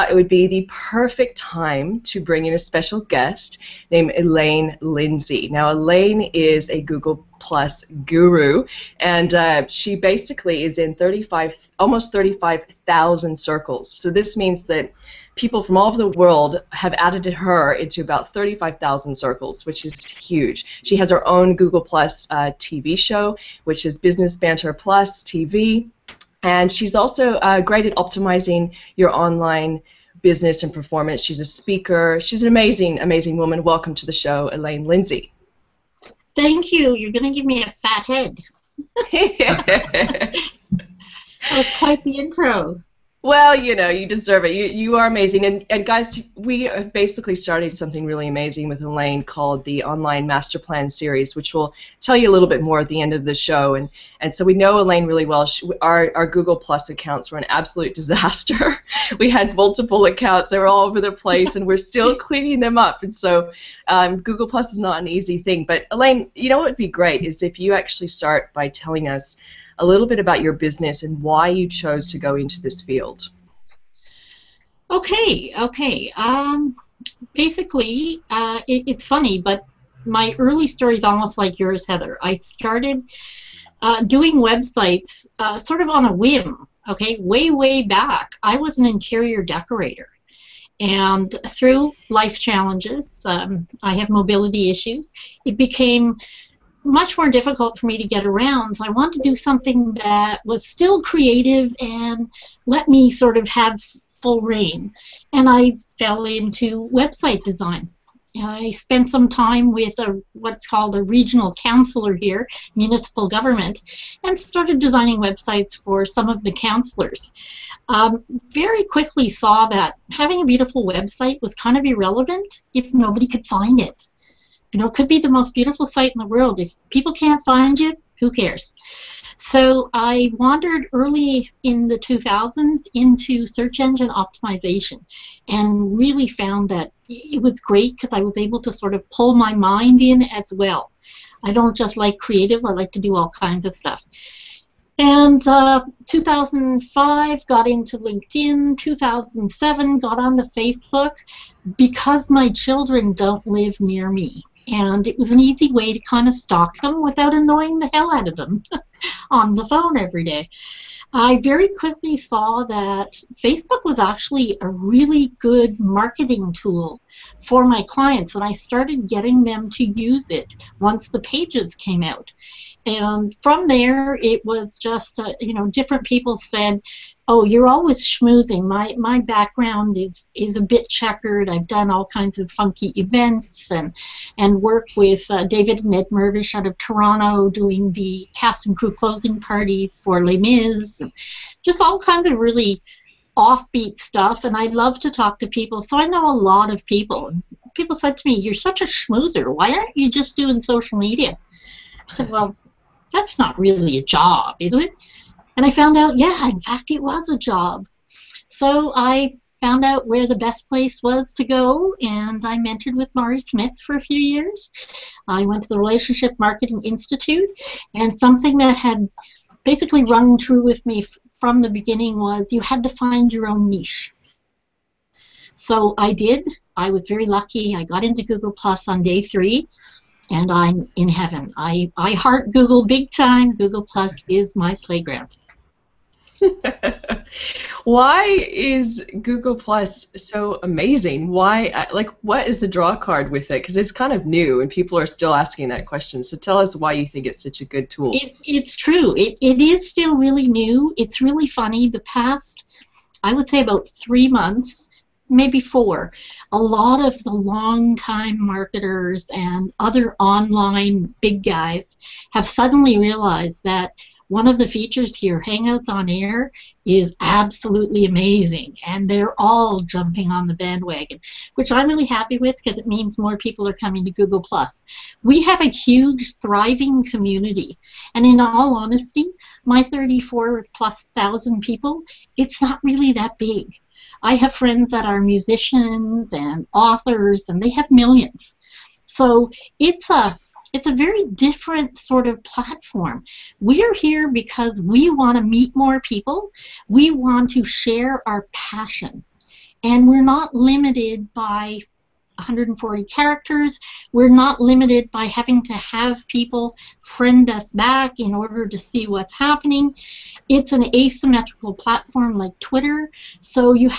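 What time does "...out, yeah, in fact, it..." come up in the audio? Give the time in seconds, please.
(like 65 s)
205 s.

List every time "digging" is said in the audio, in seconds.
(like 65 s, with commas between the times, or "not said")
not said.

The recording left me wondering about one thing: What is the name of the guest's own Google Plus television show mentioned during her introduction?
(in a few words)
Business Banter Plus TV.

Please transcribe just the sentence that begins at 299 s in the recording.
And we're not limited by 140 characters.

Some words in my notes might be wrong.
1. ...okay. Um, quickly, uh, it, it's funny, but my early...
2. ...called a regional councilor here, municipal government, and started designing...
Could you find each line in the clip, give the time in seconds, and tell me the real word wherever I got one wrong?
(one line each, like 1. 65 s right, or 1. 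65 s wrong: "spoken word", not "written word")
1. 75 s wrong: "basically", not "quickly"
2. 110 s right.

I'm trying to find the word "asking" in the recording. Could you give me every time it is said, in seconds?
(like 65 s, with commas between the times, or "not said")
245 s.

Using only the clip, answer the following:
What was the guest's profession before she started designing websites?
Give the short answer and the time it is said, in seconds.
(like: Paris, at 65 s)
Interior decorator, at 88 s.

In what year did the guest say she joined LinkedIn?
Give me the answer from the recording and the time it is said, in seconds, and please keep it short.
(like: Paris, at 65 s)
2005, at 146 s.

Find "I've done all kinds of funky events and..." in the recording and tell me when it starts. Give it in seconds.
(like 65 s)
181 s.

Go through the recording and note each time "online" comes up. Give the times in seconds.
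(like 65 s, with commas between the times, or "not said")
29 s, 49 s, 260 s.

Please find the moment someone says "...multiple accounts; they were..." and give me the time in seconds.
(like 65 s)
59 s.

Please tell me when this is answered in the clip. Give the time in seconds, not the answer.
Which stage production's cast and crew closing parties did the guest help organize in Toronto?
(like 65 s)
190 s.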